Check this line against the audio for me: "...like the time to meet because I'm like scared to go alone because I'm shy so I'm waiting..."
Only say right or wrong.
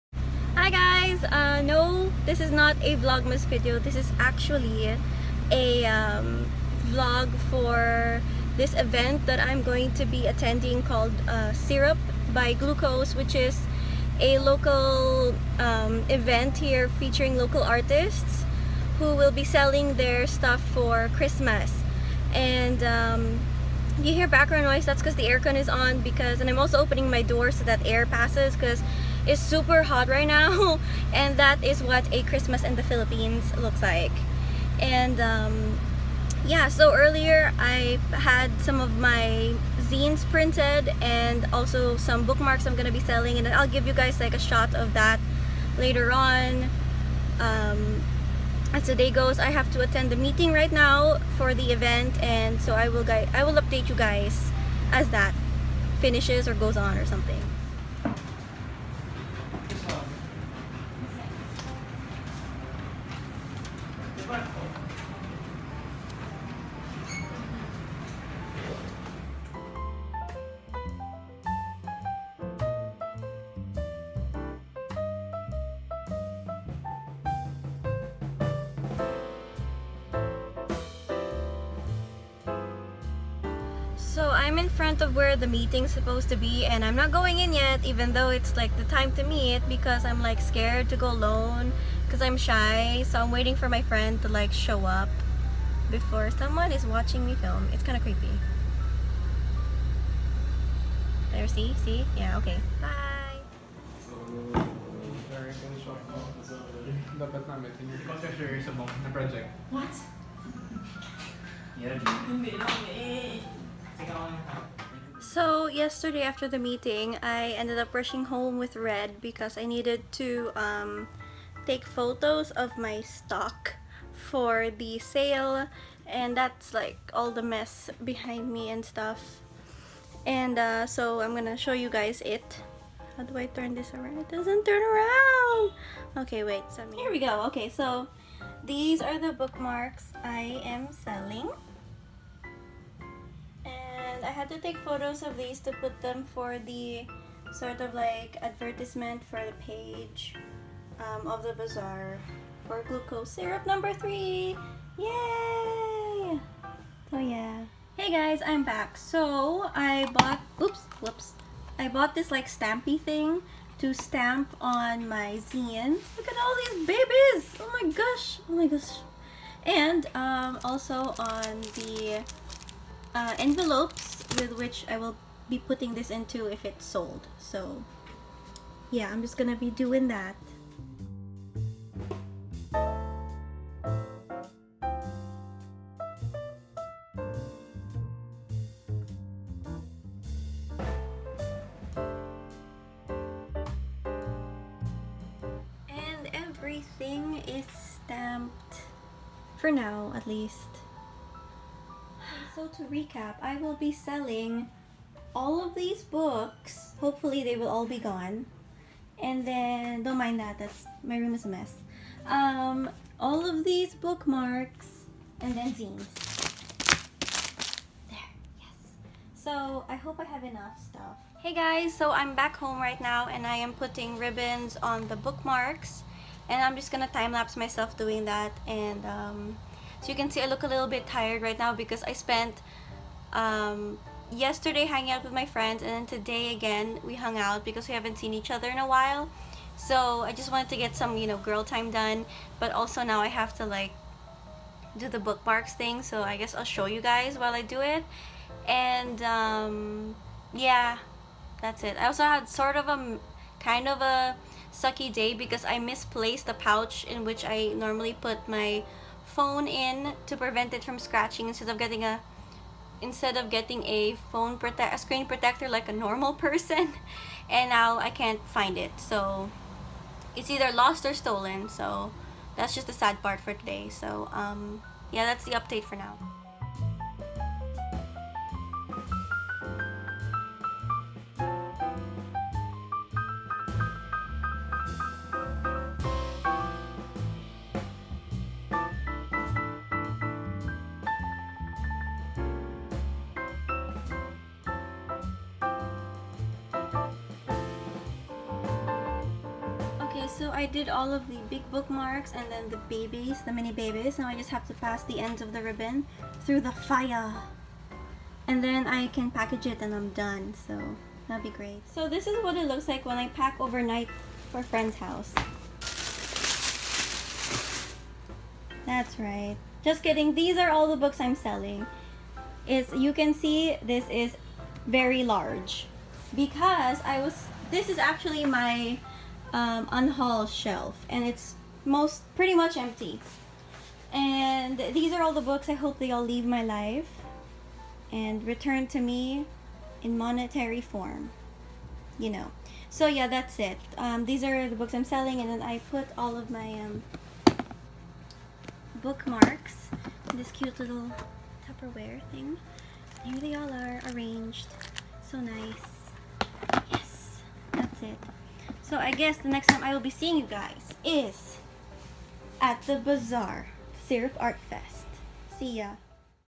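right.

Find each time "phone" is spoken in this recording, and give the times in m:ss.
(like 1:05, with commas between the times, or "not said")
4:19, 4:24.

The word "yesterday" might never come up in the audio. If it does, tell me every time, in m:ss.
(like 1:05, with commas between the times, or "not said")
1:55, 3:54.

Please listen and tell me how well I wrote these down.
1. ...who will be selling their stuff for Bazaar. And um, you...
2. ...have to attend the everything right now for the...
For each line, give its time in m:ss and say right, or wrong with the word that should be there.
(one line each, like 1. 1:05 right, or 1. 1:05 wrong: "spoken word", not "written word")
1. 0:18 wrong: "Christmas", not "Bazaar"
2. 0:49 wrong: "meeting", not "everything".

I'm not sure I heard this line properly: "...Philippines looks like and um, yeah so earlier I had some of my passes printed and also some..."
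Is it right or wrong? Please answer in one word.
wrong.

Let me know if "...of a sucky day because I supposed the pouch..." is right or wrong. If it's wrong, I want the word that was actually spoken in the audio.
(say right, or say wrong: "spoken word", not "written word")
wrong: "misplaced", not "supposed".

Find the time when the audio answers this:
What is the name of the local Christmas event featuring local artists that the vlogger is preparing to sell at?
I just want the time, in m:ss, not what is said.
0:11.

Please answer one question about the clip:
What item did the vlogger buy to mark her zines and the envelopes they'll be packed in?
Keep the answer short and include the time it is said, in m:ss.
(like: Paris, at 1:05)
stampy thing, at 2:42.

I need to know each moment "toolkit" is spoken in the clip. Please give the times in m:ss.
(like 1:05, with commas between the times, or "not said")
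not said.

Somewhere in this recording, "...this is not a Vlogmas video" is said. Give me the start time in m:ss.
0:02.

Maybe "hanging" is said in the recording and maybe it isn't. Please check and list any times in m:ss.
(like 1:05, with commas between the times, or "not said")
3:54.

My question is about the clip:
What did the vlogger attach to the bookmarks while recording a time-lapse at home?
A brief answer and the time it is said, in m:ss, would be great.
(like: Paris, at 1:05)
ribbons, at 3:44.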